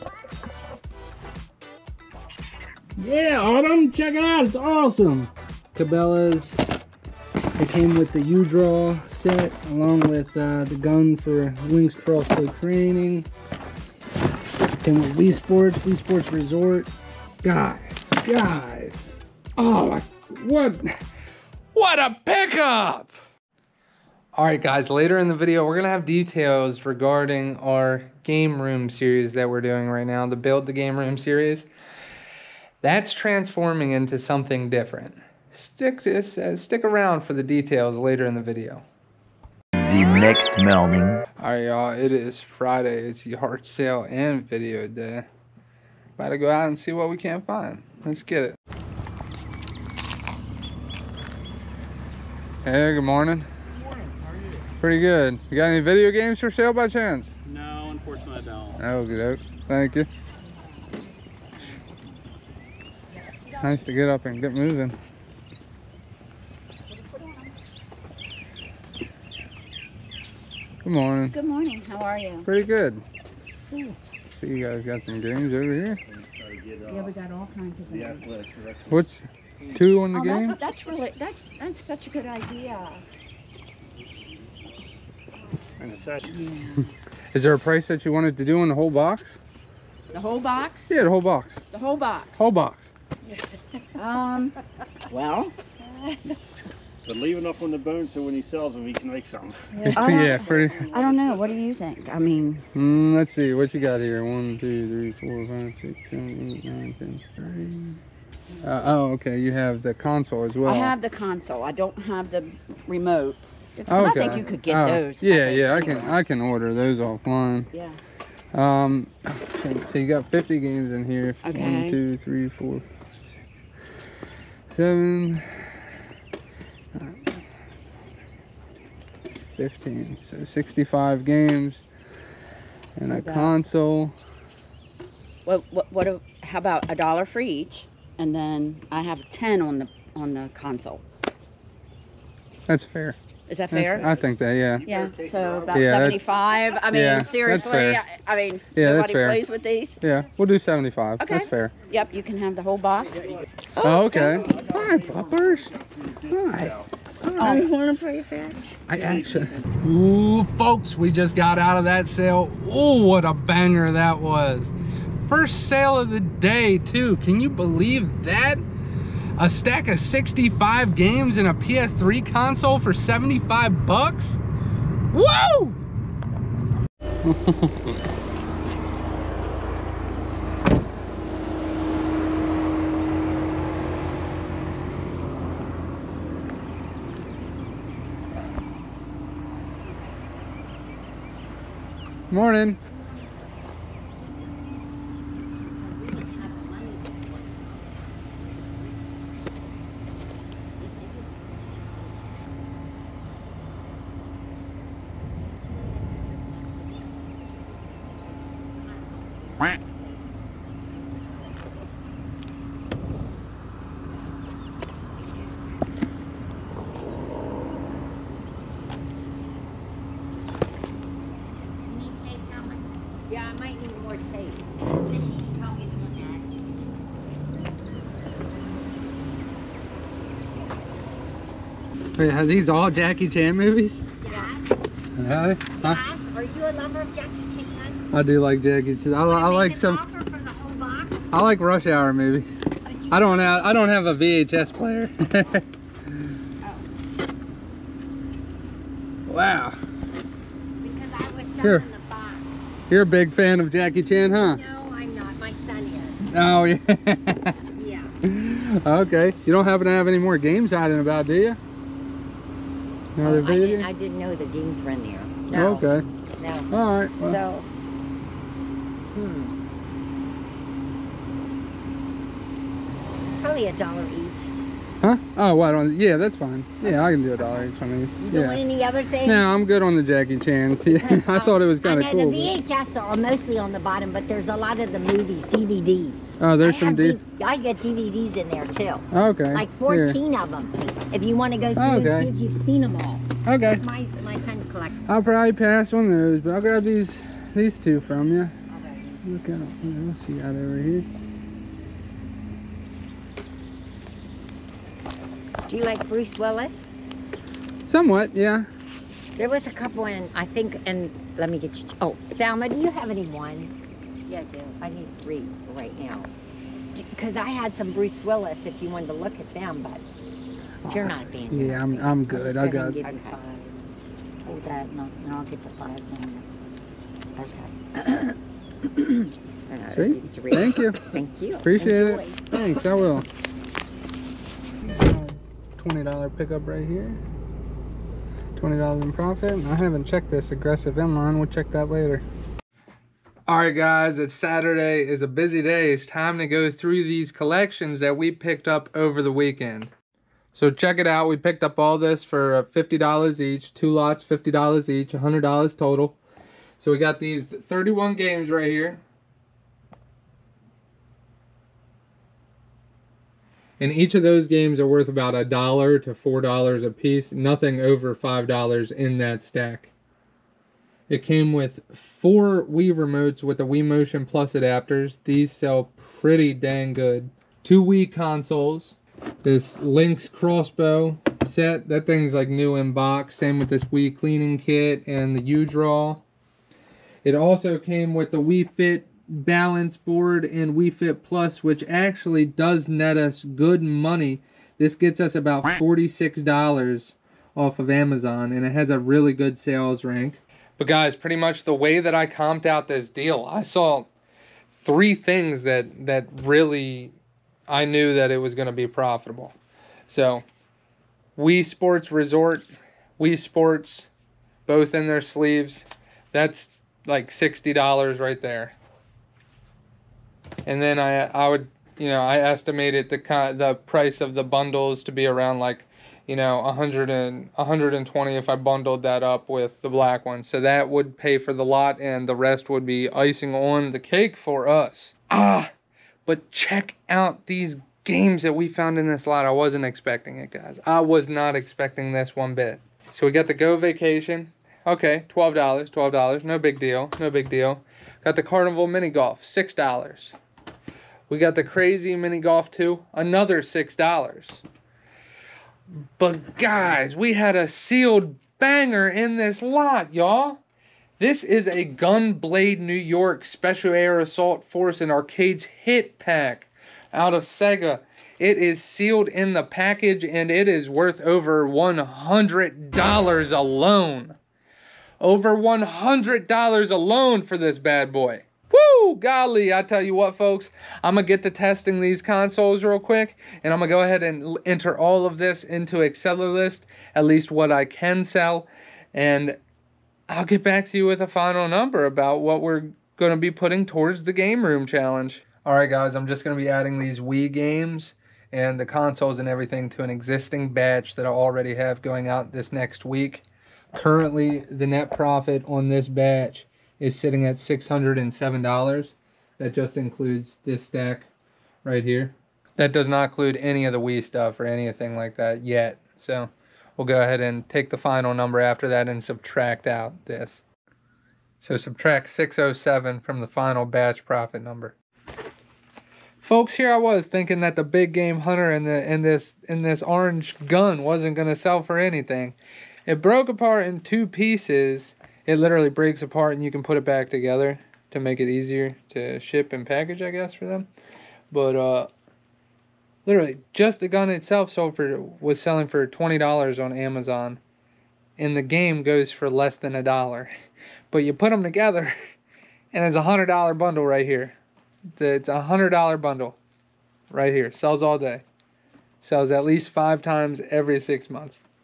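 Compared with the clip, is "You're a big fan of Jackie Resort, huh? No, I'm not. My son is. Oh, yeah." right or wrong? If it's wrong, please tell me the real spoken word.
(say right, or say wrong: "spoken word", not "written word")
wrong: "Chan", not "Resort".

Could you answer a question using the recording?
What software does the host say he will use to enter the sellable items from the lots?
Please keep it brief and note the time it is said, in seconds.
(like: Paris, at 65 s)
Accelerlist, at 485 s.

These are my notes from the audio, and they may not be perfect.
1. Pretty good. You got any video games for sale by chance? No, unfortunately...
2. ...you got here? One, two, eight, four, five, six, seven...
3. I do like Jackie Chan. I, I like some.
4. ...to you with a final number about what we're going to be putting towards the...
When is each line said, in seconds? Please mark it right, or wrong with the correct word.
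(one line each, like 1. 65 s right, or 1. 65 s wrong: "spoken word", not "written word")
1. 54 s right
2. 103 s wrong: "three", not "eight"
3. 238 s right
4. 490 s right.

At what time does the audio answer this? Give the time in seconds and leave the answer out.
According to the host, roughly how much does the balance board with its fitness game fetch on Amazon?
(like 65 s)
395 s.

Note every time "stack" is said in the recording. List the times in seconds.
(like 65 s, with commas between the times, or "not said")
169 s, 369 s, 510 s.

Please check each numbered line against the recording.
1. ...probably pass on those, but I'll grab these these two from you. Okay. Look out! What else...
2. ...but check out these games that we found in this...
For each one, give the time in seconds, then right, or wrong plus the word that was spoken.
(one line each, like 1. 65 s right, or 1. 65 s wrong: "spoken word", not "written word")
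1. 295 s right
2. 436 s right.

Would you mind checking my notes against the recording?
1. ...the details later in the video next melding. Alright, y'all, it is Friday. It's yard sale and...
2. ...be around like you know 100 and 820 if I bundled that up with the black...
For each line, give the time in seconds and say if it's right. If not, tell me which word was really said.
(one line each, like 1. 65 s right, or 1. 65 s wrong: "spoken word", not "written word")
1. 37 s right
2. 425 s wrong: "120", not "820".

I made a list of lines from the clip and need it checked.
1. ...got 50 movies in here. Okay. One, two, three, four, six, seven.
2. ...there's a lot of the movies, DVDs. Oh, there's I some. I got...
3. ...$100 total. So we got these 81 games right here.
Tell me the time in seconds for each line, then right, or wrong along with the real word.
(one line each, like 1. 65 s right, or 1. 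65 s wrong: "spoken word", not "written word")
1. 120 s wrong: "games", not "movies"
2. 284 s right
3. 355 s wrong: "31", not "81".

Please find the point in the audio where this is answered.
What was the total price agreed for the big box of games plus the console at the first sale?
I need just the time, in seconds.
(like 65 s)
150 s.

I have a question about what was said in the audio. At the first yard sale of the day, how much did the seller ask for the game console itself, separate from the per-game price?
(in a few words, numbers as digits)
10.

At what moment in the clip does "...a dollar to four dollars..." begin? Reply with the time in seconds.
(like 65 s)
365 s.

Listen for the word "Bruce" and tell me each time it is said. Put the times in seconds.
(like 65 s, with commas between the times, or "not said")
306 s, 317 s.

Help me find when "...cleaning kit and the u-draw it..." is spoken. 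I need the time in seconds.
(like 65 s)
384 s.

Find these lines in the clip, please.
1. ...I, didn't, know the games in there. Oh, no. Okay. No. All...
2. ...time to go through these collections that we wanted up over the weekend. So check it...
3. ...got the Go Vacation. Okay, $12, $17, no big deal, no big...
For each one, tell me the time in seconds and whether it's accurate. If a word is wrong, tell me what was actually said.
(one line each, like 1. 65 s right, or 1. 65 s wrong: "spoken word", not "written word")
1. 263 s right
2. 346 s wrong: "picked", not "wanted"
3. 443 s wrong: "12", not "17".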